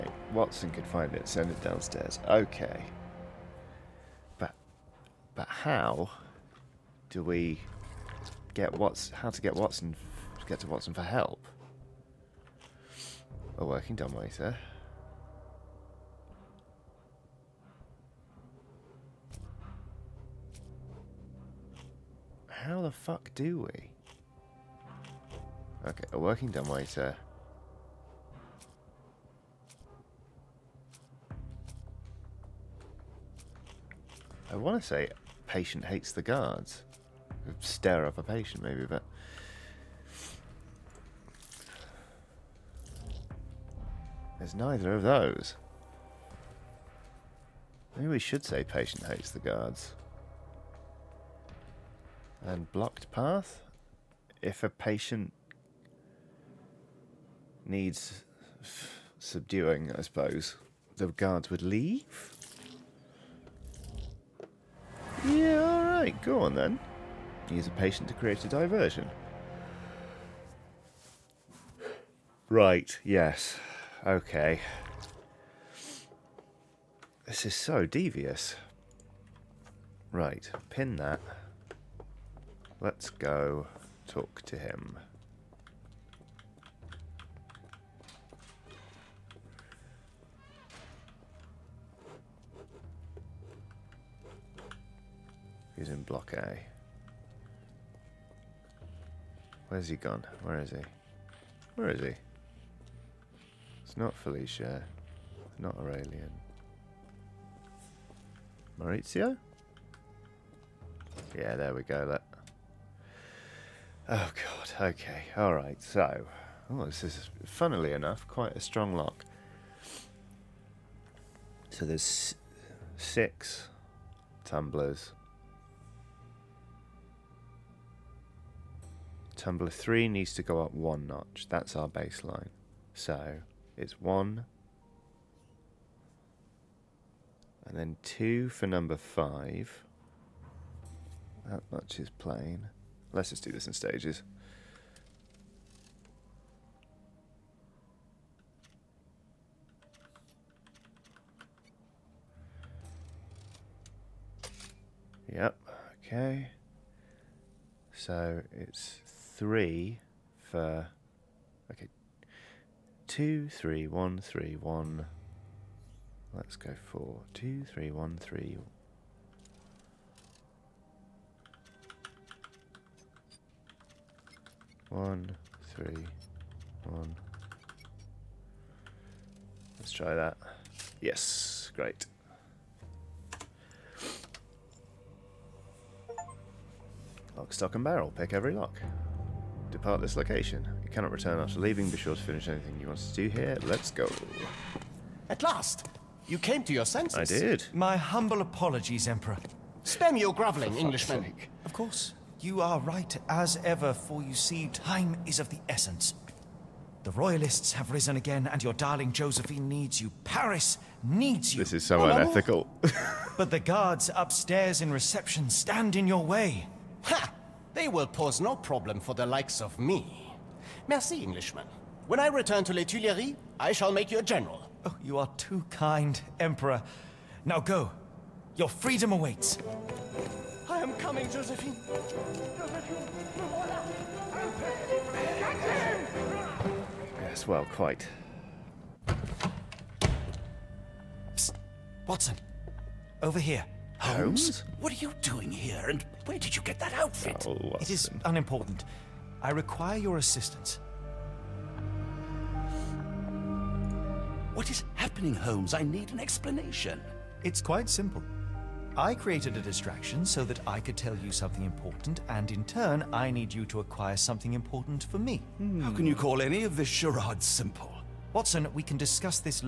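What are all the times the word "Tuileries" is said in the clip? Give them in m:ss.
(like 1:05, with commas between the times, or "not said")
3:42.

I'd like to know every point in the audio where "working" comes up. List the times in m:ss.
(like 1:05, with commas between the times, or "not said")
0:13, 0:26.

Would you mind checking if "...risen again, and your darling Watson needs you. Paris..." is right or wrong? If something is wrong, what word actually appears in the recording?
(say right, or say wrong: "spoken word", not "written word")
wrong: "Josephine", not "Watson".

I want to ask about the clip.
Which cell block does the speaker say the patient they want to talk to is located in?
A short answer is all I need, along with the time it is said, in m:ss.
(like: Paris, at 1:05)
Block A, at 1:36.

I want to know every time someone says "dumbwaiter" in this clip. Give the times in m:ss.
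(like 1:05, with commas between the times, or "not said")
0:13, 0:26.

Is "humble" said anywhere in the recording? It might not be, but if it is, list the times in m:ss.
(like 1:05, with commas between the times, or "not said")
3:17.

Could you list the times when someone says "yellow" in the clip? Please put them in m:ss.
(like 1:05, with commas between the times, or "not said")
not said.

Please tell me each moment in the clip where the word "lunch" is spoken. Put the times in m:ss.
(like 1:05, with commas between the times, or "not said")
not said.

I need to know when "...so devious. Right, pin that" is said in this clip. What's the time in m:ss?
1:17.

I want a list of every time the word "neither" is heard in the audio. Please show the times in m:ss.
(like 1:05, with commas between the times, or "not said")
0:44.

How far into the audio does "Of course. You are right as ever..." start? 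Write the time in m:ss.
3:21.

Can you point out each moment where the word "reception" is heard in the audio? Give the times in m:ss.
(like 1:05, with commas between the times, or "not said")
3:34.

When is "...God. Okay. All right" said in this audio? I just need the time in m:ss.
1:54.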